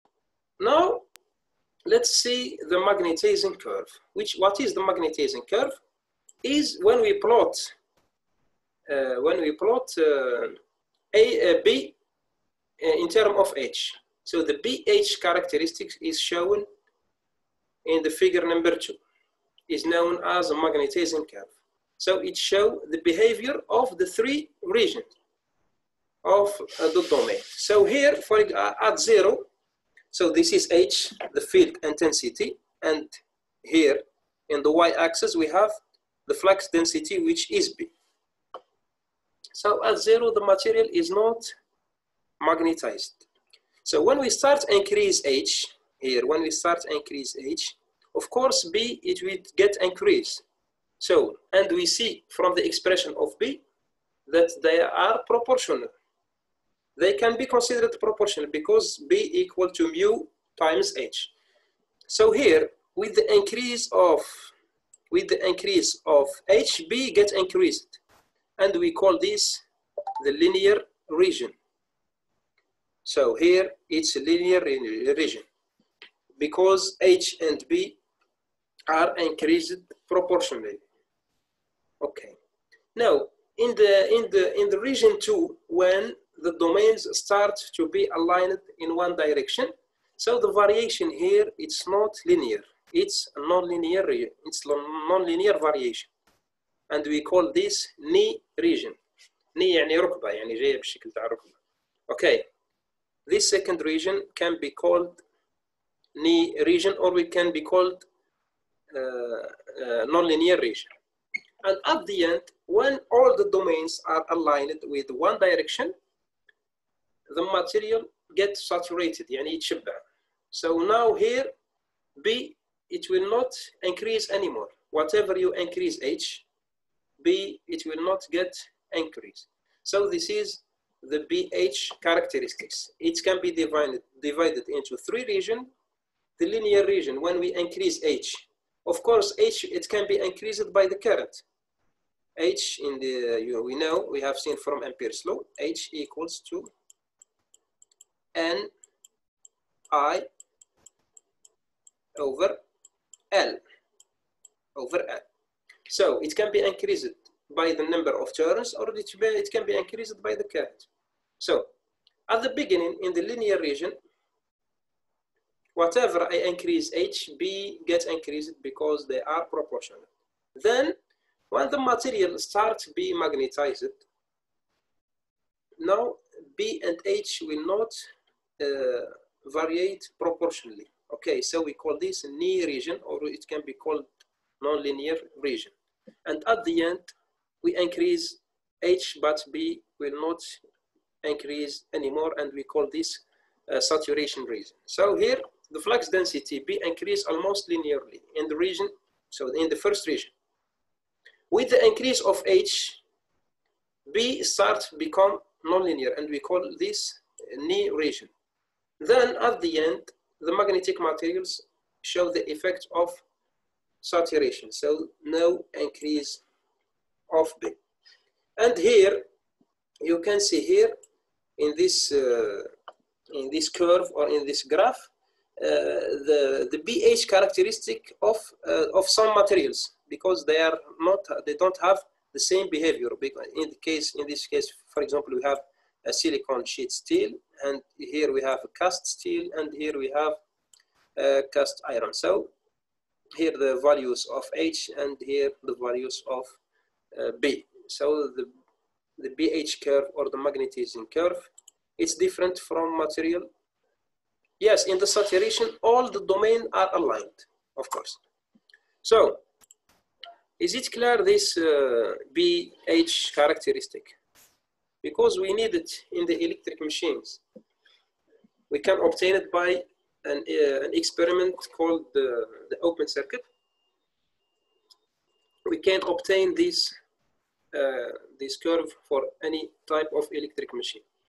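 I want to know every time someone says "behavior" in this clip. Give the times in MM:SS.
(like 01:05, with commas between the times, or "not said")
00:23, 03:52.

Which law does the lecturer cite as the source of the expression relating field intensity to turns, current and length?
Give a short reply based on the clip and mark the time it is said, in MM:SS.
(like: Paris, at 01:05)
Ampere's law, at 02:24.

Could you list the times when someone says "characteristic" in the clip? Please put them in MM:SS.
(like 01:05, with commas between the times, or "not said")
00:15, 02:12, 03:47, 04:23.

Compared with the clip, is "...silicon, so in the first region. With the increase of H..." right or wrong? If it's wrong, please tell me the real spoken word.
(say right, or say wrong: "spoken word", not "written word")
wrong: "region", not "silicon".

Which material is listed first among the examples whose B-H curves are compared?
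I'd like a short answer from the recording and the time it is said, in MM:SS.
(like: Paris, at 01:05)
silicon sheet steel, at 03:56.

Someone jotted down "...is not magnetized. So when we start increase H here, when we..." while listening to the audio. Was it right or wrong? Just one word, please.
right.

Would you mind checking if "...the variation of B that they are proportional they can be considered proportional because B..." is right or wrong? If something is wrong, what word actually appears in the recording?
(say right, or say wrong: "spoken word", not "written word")
wrong: "expression", not "variation".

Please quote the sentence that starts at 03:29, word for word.
Then at the end, the magnetic materials show the effect of saturation.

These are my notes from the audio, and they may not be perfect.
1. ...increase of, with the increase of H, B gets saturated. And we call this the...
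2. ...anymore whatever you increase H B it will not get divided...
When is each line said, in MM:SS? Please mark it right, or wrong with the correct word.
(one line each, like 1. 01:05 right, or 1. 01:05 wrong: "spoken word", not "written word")
1. 01:03 wrong: "increased", not "saturated"
2. 02:04 wrong: "increased", not "divided".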